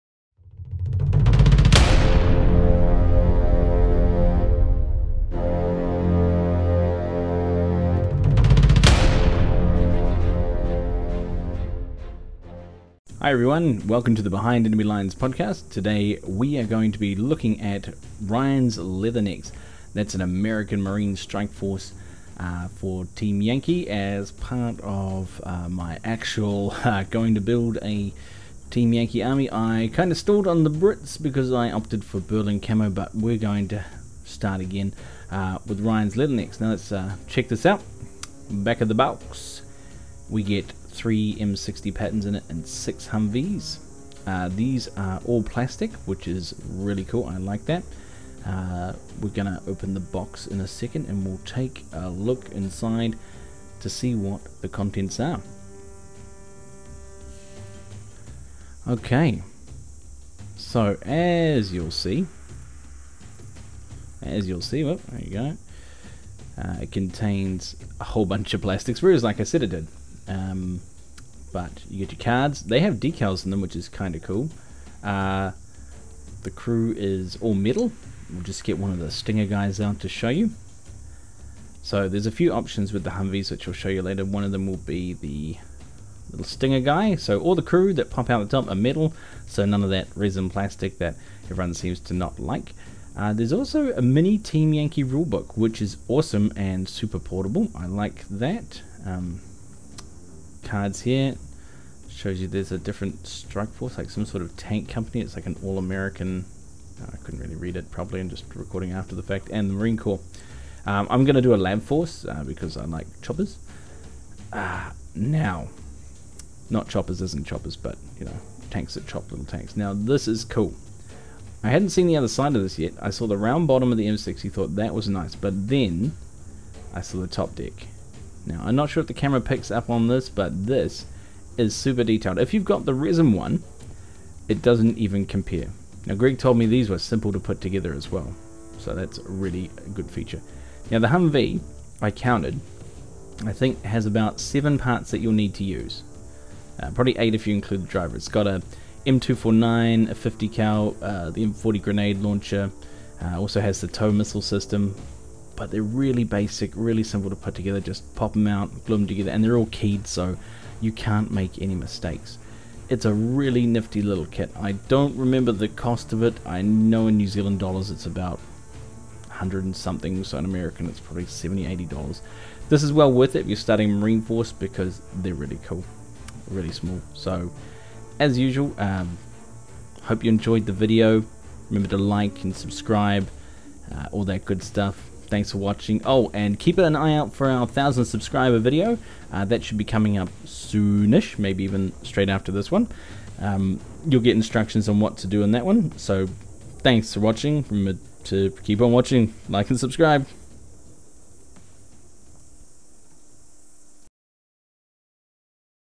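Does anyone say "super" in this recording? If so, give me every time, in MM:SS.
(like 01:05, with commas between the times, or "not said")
01:36, 02:11.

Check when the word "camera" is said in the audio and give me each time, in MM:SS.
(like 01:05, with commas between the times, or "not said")
02:09.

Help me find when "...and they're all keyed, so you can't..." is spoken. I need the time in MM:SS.
02:39.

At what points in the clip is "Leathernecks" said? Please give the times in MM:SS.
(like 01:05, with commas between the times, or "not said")
00:18, 00:36.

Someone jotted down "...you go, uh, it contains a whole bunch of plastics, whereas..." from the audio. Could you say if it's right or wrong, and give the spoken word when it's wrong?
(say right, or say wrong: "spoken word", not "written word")
right.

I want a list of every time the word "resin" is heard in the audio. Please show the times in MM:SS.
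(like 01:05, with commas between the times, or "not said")
01:30, 02:12.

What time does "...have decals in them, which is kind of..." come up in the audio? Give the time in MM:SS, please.
01:12.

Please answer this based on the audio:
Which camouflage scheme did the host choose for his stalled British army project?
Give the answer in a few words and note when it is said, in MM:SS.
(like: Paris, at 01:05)
Berlin Camo, at 00:32.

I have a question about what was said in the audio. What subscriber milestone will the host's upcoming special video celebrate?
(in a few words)
1,000 subscribers.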